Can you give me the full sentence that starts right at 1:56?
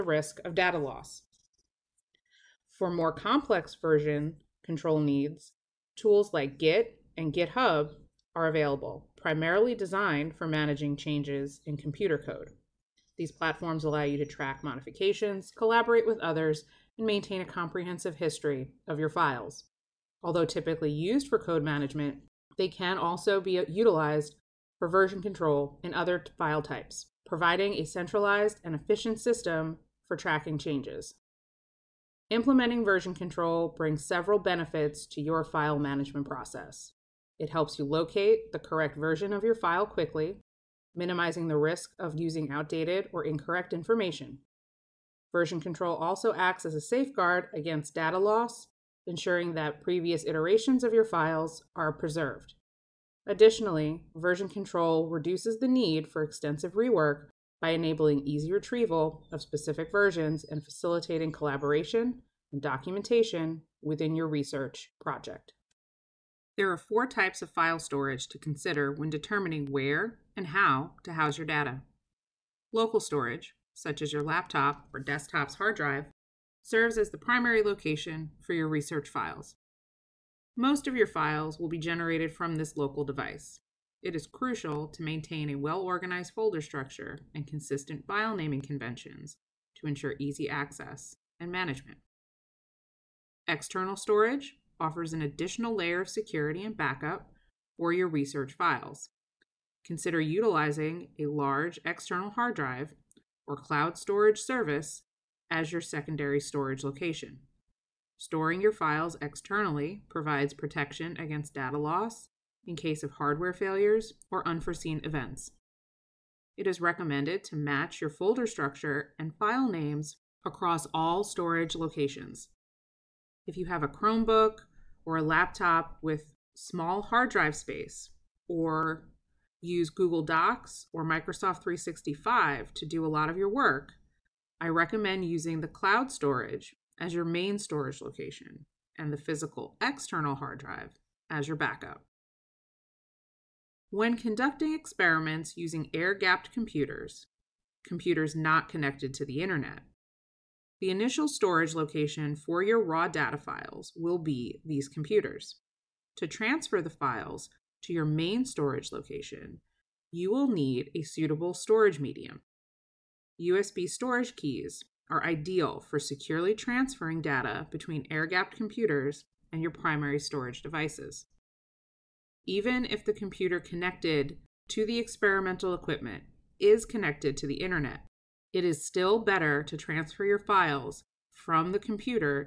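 It is recommended to match your folder structure and file names across all storage locations.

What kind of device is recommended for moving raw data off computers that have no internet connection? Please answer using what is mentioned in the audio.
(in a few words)
USB storage keys.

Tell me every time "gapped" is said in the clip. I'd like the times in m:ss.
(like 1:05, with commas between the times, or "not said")
2:26, 2:48.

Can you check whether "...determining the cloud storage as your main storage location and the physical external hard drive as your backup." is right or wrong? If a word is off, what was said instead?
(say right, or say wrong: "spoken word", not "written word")
wrong: "using", not "determining".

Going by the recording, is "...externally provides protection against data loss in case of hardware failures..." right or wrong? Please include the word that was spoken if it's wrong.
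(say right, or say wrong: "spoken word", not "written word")
right.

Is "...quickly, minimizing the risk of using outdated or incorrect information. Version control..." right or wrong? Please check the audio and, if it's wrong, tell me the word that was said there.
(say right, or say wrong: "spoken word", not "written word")
right.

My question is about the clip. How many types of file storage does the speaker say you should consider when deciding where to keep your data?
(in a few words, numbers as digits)
4.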